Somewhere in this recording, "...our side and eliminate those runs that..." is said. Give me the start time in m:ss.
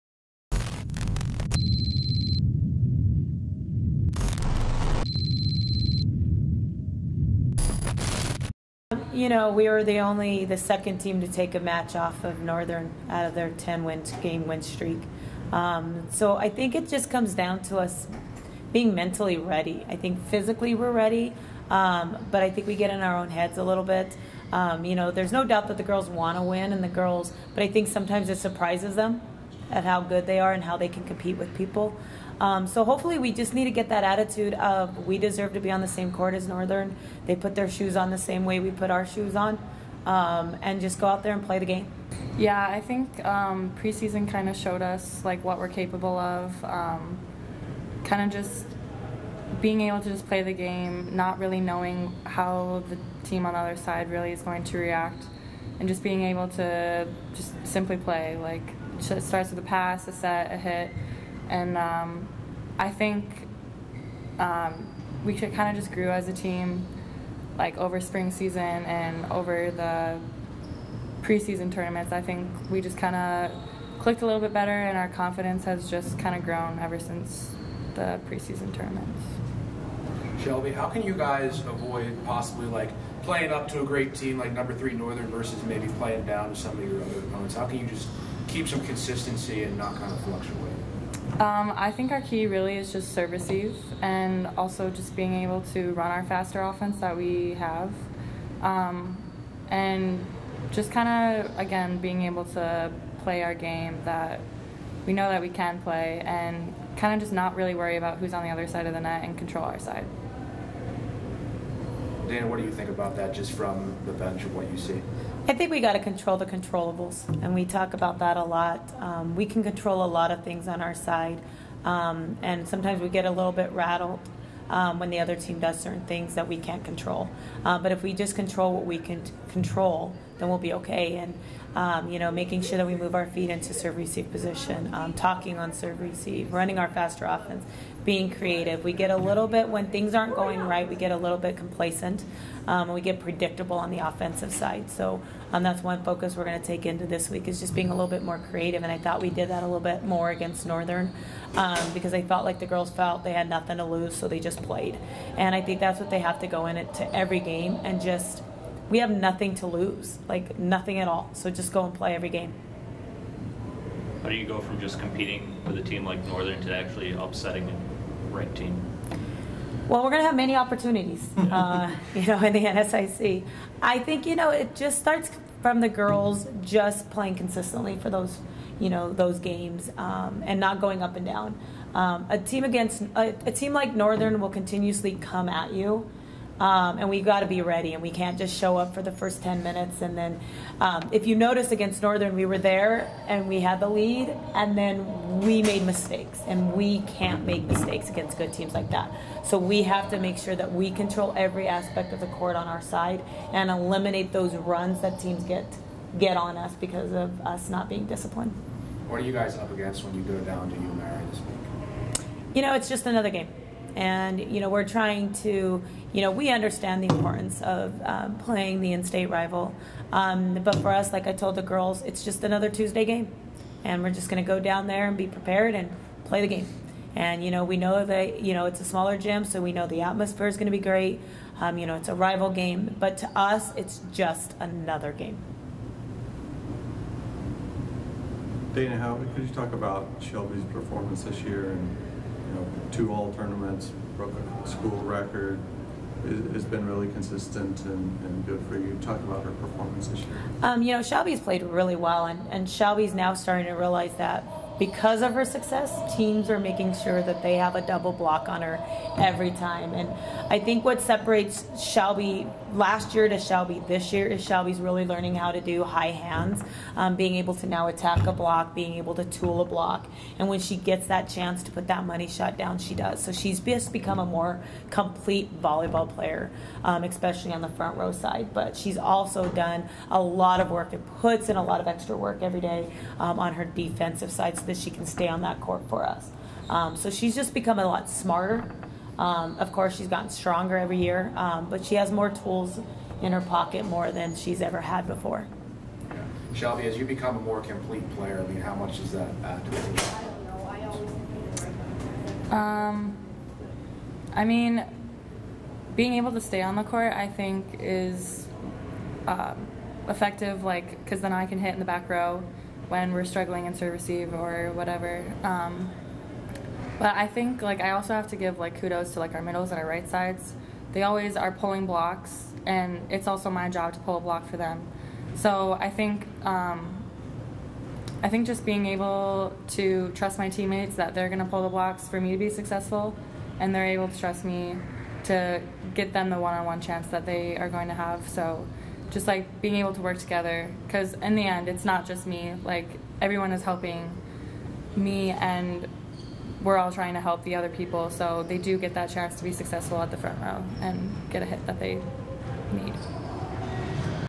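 3:22.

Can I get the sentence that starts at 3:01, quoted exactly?
Um, a team against a, a team like Northern will continuously come at you.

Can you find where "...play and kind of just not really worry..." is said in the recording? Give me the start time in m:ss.
1:45.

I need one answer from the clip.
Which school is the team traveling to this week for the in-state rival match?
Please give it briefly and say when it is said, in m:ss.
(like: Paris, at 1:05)
UMary, at 3:30.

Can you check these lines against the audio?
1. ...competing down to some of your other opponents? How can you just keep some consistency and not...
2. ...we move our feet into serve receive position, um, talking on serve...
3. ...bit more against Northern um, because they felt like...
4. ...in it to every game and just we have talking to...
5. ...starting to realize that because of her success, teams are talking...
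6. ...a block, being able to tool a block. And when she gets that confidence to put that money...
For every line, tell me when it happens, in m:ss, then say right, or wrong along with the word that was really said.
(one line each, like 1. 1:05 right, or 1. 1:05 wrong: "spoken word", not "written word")
1. 1:25 wrong: "playing", not "competing"
2. 2:12 right
3. 2:29 right
4. 2:36 wrong: "nothing", not "talking"
5. 4:13 wrong: "making", not "talking"
6. 4:28 wrong: "chance", not "confidence".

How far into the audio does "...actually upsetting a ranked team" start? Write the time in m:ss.
2:46.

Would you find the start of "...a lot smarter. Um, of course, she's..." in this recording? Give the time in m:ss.
4:47.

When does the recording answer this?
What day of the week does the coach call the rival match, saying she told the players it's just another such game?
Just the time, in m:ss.
3:42.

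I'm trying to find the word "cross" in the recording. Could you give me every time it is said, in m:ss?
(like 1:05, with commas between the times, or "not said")
not said.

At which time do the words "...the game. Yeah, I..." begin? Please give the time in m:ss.
0:41.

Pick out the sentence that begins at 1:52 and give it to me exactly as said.
Dana, what do you think about that just from the bench of what you see?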